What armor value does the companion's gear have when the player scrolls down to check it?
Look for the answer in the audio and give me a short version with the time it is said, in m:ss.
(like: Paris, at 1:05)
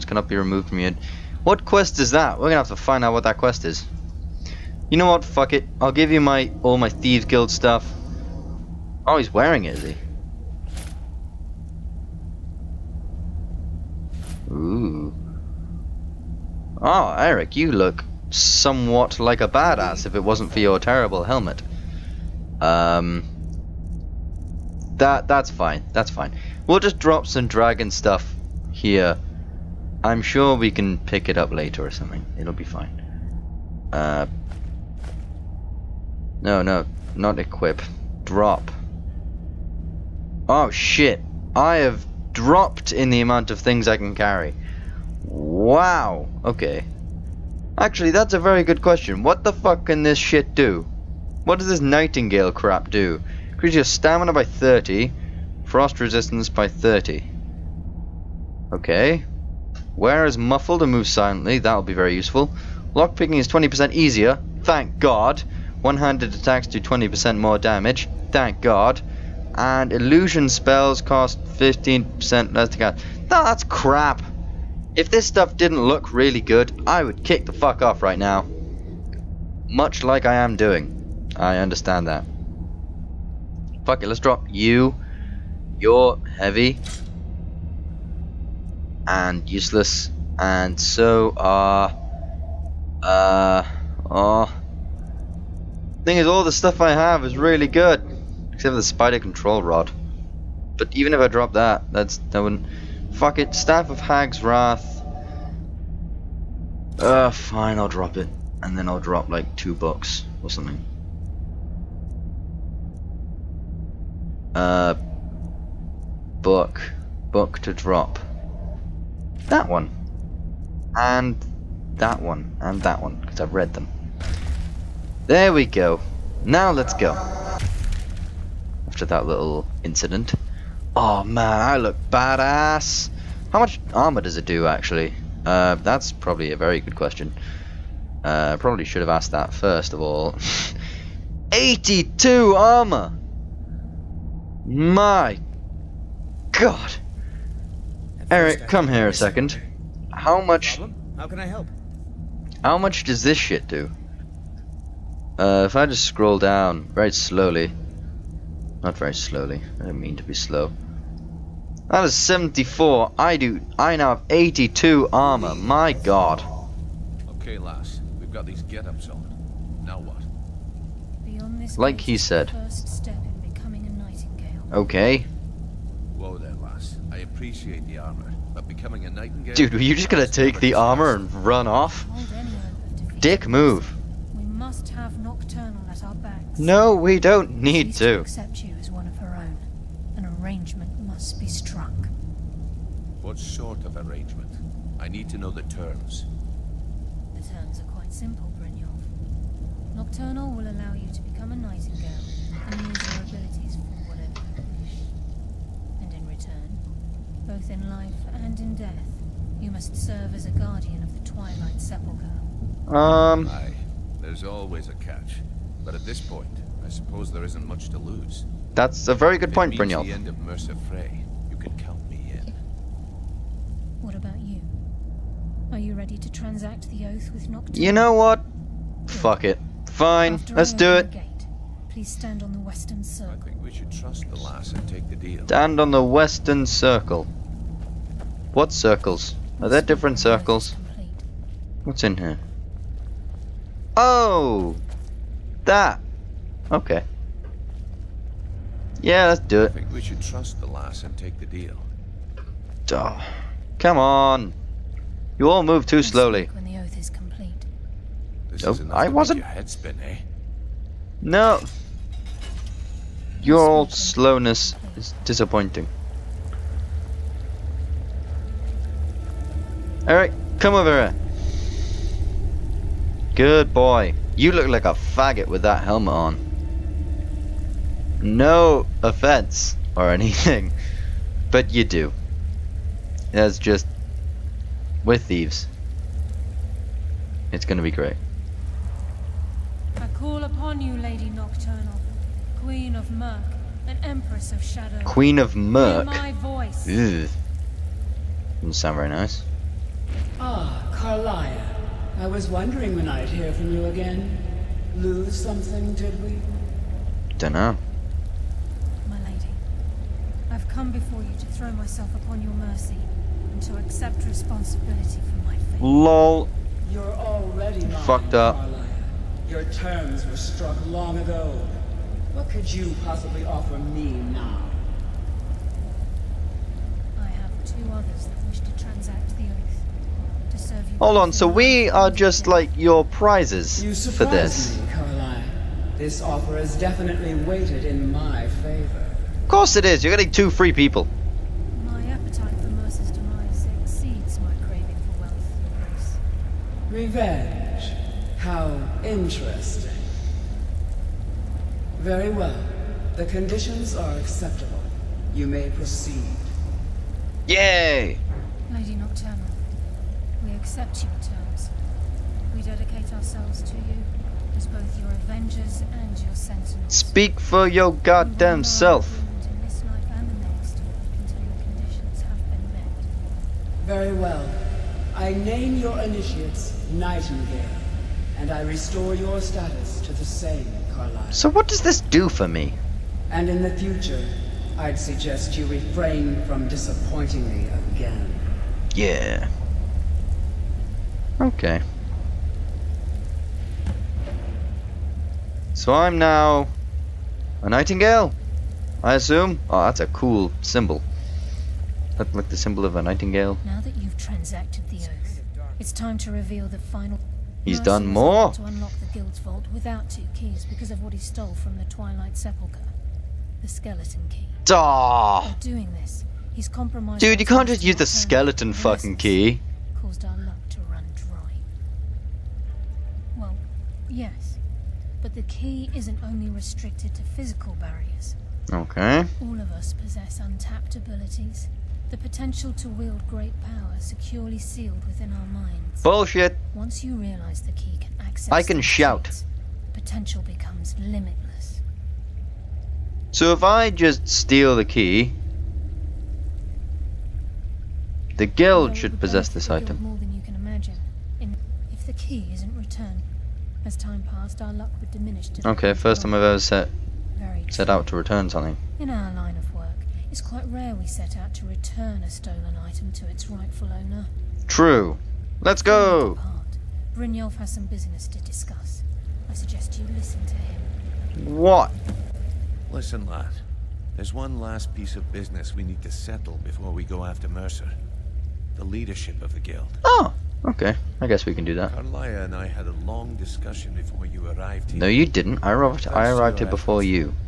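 74, at 2:41.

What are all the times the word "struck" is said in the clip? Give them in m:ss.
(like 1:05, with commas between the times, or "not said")
3:11, 5:20.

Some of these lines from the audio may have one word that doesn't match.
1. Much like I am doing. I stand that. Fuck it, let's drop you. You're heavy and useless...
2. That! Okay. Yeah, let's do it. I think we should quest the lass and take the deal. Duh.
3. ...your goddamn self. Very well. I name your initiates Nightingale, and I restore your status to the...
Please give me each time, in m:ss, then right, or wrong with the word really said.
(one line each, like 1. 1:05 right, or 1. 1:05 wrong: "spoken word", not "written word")
1. 1:19 wrong: "understand", not "stand"
2. 4:05 wrong: "trust", not "quest"
3. 6:07 right.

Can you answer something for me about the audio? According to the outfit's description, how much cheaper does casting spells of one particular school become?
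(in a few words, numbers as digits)
15%.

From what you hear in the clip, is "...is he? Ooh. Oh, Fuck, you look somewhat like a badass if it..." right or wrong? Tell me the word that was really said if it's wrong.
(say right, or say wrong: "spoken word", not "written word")
wrong: "Eric", not "Fuck".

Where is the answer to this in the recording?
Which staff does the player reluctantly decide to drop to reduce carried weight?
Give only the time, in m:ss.
1:43.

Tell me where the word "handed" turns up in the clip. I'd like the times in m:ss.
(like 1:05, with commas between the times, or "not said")
1:05.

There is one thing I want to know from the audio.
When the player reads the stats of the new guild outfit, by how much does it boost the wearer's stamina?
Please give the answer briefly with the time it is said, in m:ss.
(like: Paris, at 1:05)
30, at 0:53.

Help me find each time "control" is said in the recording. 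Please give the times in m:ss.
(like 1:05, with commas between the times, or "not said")
1:39.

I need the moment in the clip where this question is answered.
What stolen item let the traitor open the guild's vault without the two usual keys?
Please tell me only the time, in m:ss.
6:53.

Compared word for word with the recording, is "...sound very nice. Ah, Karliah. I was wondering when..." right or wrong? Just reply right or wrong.
right.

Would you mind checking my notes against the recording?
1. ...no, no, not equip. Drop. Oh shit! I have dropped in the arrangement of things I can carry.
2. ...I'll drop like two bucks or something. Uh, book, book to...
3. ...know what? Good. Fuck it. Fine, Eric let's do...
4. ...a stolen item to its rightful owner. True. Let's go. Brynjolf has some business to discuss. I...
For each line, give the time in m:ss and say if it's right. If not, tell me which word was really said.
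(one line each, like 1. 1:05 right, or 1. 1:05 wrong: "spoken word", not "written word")
1. 0:36 wrong: "amount", not "arrangement"
2. 1:48 right
3. 3:47 wrong: "After", not "Eric"
4. 7:42 right.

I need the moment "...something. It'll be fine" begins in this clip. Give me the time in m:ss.
0:31.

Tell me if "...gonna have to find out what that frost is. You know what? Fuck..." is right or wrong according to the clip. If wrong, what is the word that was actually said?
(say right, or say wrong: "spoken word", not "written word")
wrong: "quest", not "frost".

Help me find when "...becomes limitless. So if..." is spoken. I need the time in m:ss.
7:20.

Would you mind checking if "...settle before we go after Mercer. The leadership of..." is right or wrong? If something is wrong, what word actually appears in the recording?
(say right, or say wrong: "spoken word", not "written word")
right.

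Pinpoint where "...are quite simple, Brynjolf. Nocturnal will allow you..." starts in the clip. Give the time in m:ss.
3:17.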